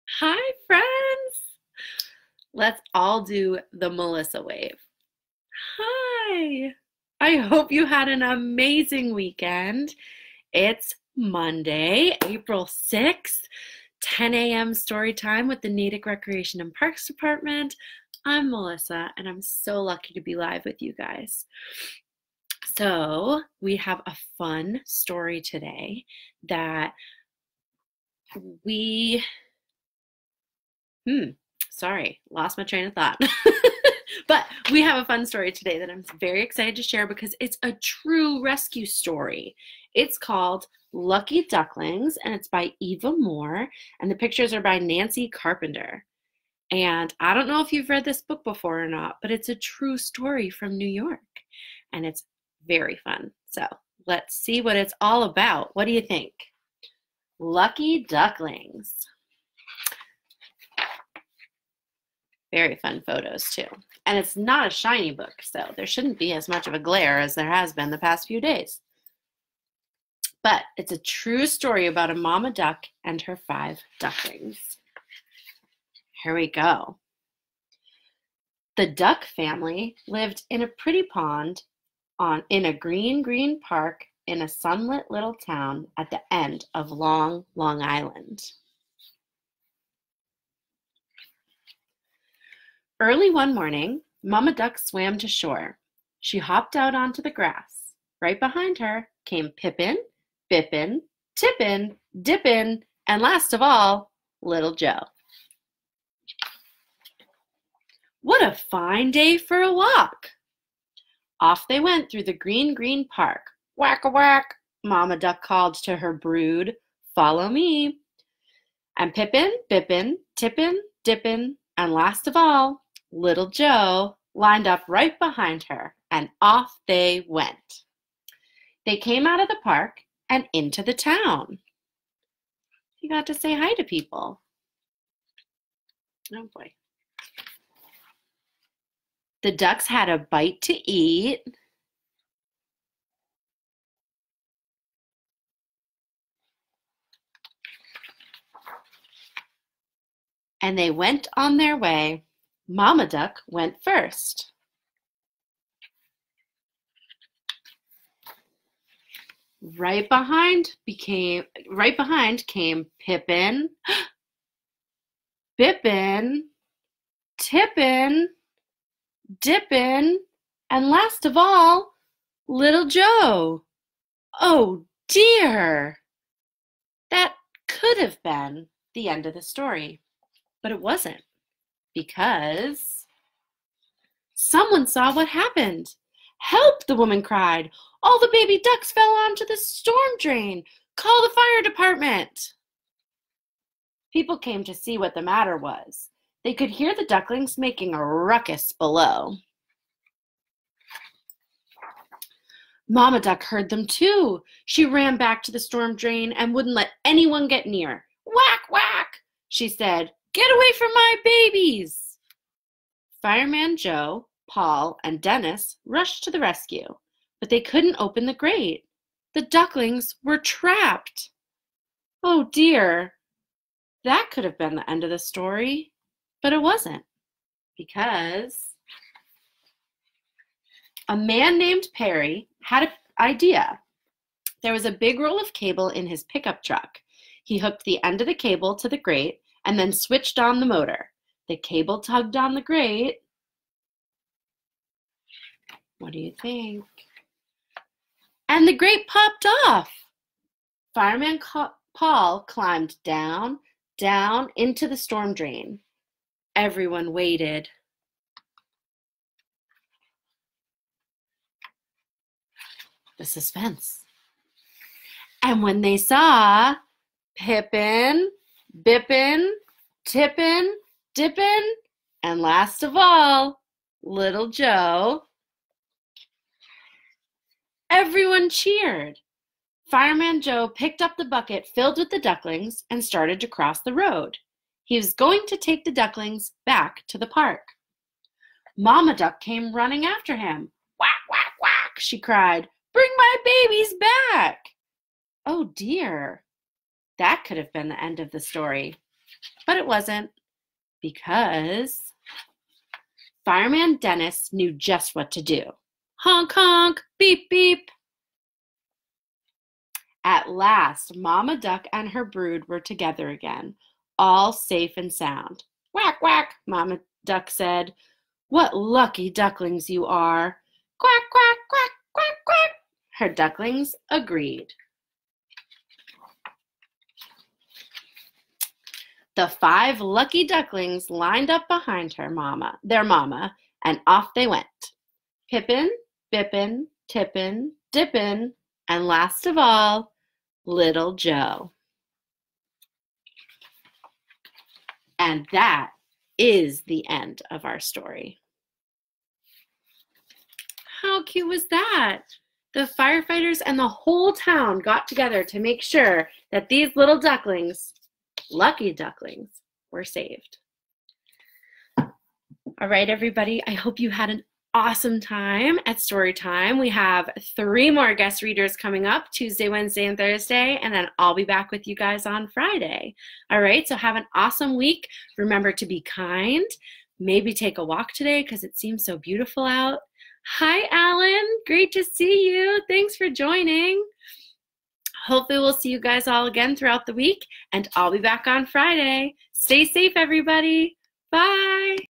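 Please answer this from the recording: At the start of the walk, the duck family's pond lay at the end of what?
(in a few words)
long long island.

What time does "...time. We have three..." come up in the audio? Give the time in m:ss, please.
6:06.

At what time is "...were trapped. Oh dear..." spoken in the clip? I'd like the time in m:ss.
3:40.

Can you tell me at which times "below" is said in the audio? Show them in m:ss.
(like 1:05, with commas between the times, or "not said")
3:18.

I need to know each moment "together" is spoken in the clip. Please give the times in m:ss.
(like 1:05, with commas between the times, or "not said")
5:12, 5:55.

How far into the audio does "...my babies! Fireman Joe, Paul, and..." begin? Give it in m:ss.
3:30.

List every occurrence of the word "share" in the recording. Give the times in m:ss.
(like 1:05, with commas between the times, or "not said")
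0:36.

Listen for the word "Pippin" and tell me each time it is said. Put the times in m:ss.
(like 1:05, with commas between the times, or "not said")
1:39, 1:59, 2:43, 4:27, 5:35.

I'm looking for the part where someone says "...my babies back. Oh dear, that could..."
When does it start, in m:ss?
4:53.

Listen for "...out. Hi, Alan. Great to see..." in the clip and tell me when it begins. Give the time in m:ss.
6:19.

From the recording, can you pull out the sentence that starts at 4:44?
He was going to take the ducklings back to the park.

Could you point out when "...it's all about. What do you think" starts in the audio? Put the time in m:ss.
0:54.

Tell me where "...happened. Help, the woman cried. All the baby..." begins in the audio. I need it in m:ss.
3:05.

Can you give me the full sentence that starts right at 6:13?
All right, so have an awesome week.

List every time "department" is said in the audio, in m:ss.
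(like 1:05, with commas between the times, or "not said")
0:17, 3:11.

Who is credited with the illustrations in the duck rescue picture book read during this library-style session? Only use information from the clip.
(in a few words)
Nancy Carpenter.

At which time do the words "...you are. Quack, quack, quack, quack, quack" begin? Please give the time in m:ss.
5:19.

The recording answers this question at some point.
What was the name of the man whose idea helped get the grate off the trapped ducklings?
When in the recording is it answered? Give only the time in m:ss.
3:51.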